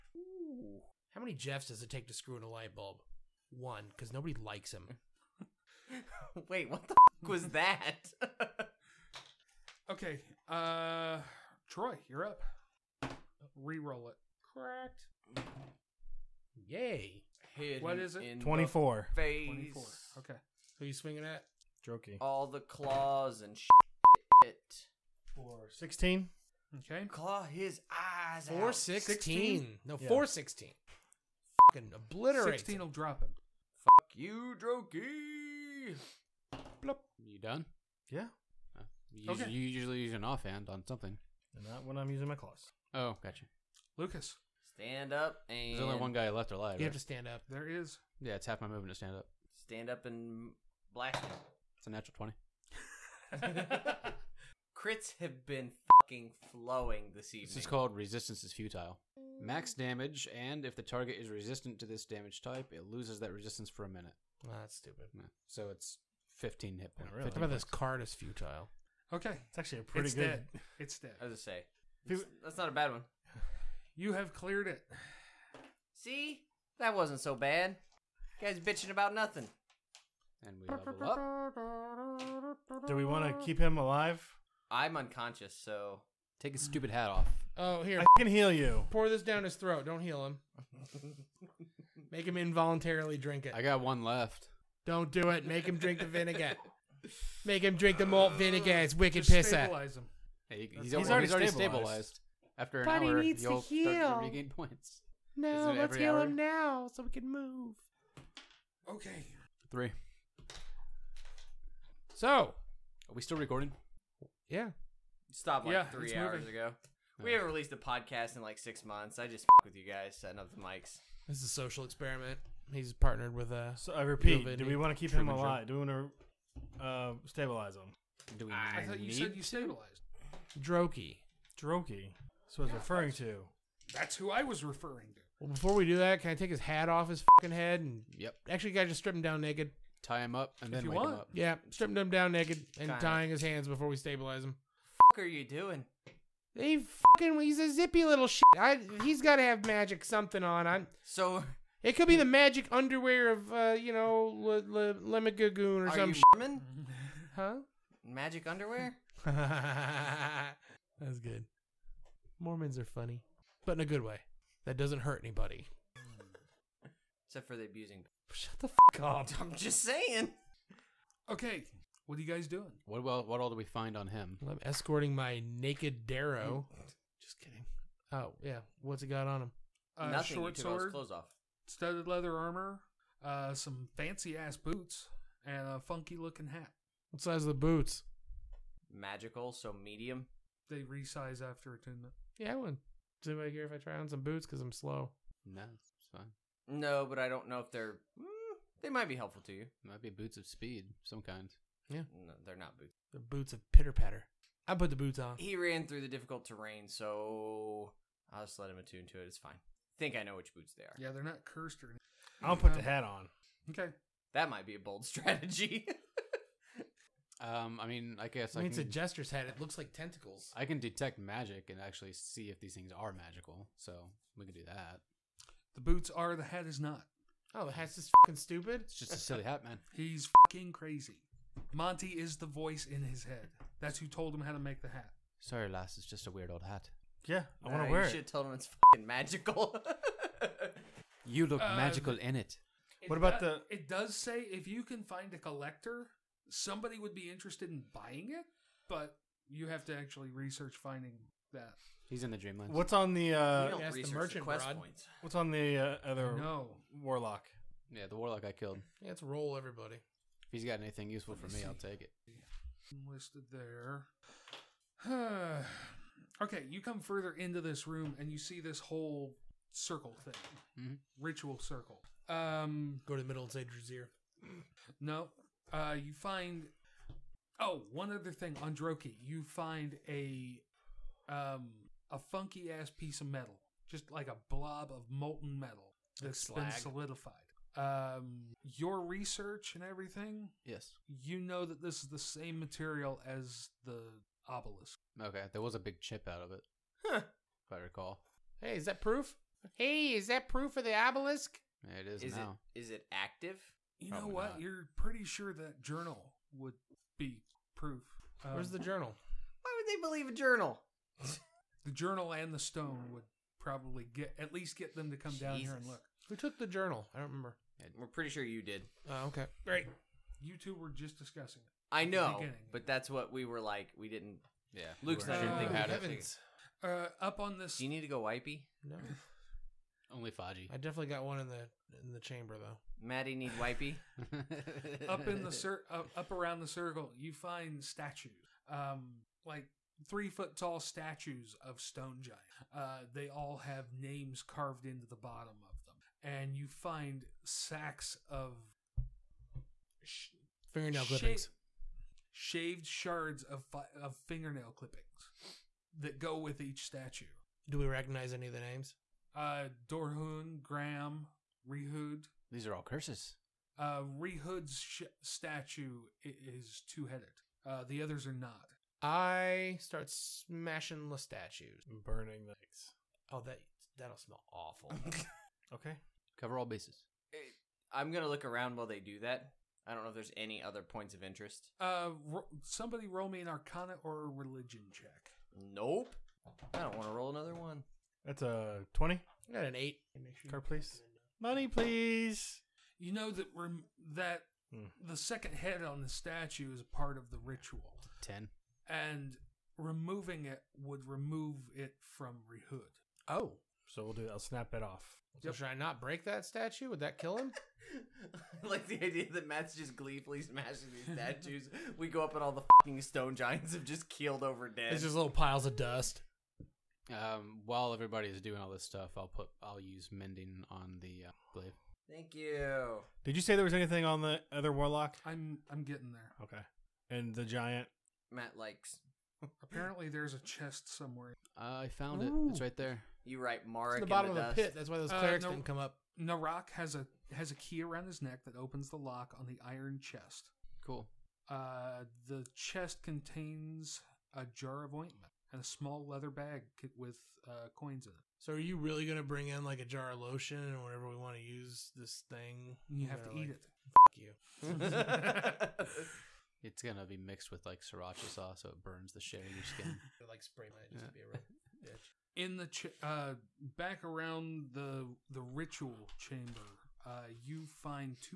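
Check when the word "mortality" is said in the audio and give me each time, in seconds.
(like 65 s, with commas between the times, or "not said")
not said.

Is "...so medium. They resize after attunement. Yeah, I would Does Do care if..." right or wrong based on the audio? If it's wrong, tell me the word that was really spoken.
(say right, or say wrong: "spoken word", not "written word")
right.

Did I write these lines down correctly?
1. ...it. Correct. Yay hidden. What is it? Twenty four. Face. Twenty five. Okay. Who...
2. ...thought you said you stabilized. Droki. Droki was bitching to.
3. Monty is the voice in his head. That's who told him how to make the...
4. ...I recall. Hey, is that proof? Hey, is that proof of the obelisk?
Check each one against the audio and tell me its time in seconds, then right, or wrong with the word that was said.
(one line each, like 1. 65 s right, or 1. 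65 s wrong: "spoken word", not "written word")
1. 14 s wrong: "four", not "five"
2. 128 s wrong: "referring", not "bitching"
3. 231 s right
4. 297 s right.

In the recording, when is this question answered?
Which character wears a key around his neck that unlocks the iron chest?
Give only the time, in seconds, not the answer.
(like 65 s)
436 s.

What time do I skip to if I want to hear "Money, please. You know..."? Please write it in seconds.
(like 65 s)
391 s.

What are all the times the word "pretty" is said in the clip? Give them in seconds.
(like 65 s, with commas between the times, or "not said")
69 s, 304 s, 318 s.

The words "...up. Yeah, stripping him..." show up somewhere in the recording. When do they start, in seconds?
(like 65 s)
141 s.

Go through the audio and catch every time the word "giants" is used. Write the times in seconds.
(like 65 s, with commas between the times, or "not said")
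342 s, 413 s, 427 s.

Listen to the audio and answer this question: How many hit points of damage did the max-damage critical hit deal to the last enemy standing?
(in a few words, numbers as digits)
15.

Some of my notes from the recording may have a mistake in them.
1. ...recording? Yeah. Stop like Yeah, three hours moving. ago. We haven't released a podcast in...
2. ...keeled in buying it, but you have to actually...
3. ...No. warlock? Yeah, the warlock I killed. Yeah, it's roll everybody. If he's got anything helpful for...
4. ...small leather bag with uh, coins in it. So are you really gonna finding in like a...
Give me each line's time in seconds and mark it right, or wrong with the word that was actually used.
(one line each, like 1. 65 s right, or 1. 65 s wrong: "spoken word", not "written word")
1. 113 s right
2. 247 s wrong: "interested", not "keeled"
3. 256 s wrong: "useful", not "helpful"
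4. 445 s wrong: "bring", not "finding".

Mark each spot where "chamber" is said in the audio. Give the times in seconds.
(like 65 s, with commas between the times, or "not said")
332 s, 466 s.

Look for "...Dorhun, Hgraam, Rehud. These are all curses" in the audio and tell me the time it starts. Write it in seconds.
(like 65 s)
359 s.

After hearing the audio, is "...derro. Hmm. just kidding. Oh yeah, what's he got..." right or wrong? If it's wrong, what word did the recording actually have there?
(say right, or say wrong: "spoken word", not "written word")
right.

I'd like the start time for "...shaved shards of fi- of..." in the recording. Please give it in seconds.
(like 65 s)
352 s.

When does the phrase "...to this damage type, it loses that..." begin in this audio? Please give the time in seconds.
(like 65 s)
61 s.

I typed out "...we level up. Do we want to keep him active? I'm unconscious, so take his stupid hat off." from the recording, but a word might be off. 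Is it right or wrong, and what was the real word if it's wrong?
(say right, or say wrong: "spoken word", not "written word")
wrong: "alive", not "active".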